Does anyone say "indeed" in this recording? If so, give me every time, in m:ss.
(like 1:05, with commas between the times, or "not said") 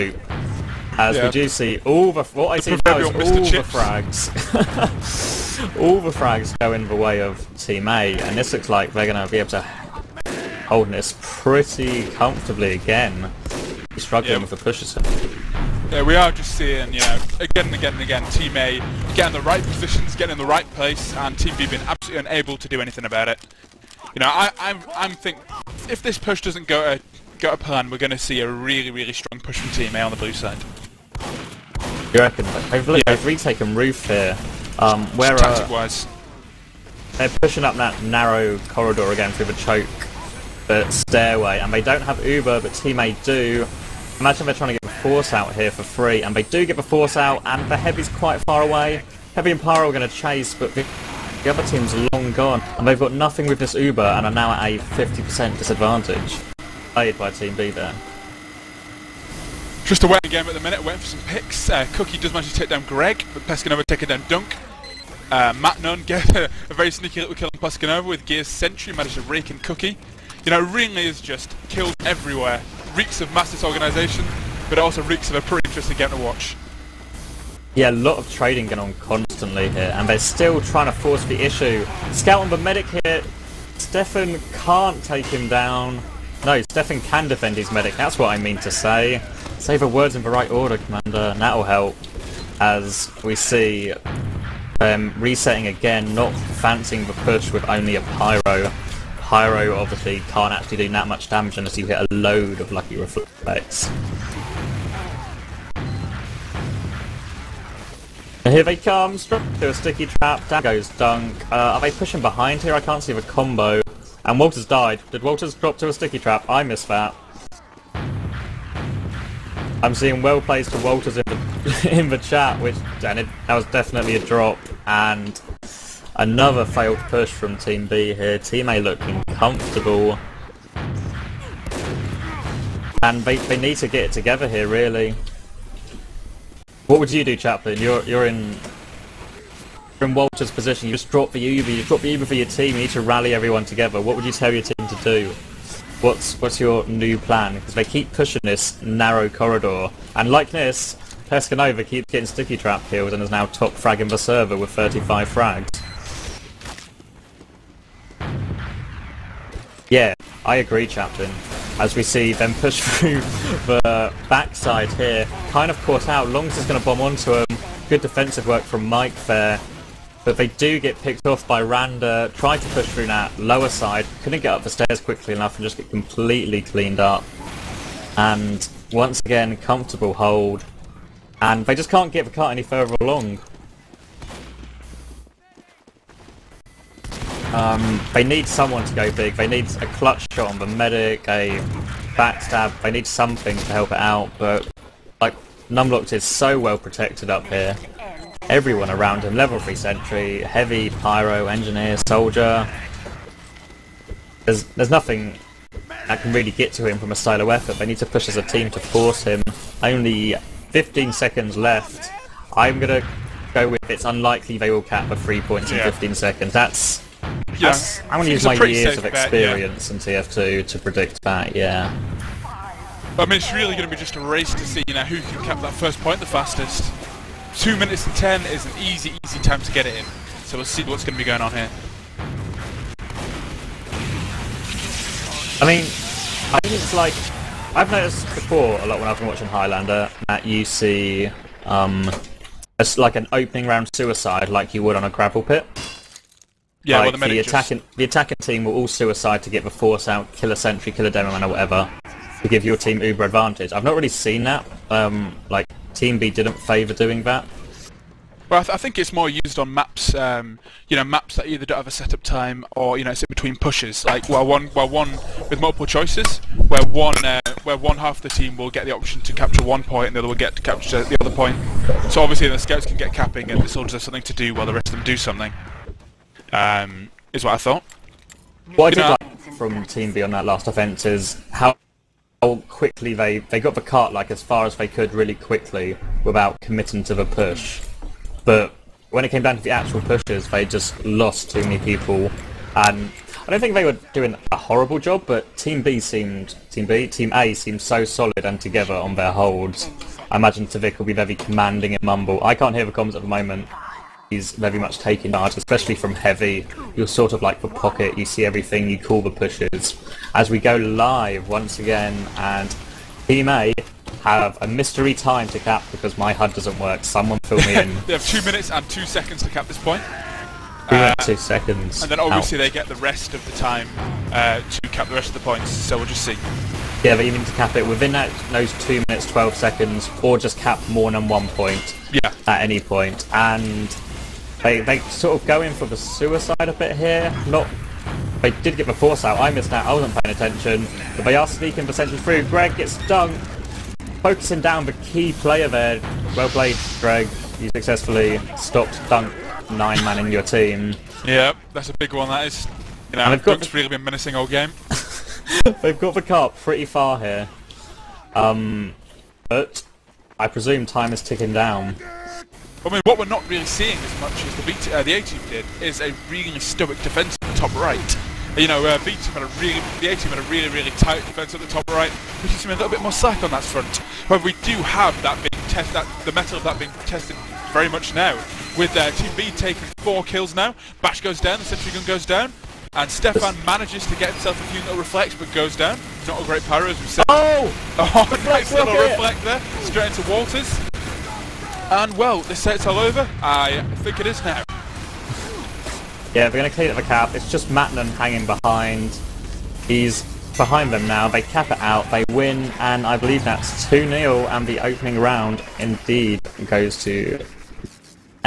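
6:45.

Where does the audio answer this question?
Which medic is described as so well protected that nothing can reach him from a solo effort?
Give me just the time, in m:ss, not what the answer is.
3:15.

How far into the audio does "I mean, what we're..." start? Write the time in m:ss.
6:02.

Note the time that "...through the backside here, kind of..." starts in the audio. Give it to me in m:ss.
2:42.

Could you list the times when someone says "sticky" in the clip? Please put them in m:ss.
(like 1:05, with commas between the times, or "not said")
1:49, 1:55, 2:32.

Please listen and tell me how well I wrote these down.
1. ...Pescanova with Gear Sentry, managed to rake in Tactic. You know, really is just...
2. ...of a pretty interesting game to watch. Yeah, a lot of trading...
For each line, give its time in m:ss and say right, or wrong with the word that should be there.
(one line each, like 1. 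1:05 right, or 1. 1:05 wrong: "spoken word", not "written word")
1. 1:07 wrong: "Cookye", not "Tactic"
2. 1:15 right.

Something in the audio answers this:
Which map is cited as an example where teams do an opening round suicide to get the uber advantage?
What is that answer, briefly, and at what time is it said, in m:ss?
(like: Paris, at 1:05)
Gravel Pit, at 4:05.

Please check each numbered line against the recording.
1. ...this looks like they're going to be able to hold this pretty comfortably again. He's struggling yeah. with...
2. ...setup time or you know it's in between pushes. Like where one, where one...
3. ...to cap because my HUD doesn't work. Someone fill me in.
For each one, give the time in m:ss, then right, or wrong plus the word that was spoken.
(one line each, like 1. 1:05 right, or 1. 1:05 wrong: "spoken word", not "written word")
1. 0:08 right
2. 4:21 right
3. 5:15 right.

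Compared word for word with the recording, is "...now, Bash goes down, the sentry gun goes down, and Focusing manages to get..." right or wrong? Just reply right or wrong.
wrong.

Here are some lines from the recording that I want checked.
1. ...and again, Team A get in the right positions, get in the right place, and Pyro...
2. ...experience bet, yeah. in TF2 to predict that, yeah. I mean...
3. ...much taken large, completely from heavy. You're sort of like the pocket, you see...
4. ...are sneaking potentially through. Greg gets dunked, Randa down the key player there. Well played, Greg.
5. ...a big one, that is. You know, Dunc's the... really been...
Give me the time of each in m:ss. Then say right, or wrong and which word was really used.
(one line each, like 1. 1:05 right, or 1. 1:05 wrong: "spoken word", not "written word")
1. 0:17 wrong: "Team", not "Pyro"
2. 3:39 right
3. 5:04 wrong: "especially", not "completely"
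4. 5:41 wrong: "Focusing", not "Randa"
5. 5:51 right.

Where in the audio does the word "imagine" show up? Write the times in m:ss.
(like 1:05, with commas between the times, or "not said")
0:44, 5:00.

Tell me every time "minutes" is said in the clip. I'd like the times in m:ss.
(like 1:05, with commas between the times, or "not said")
1:00, 3:47, 5:18, 5:29.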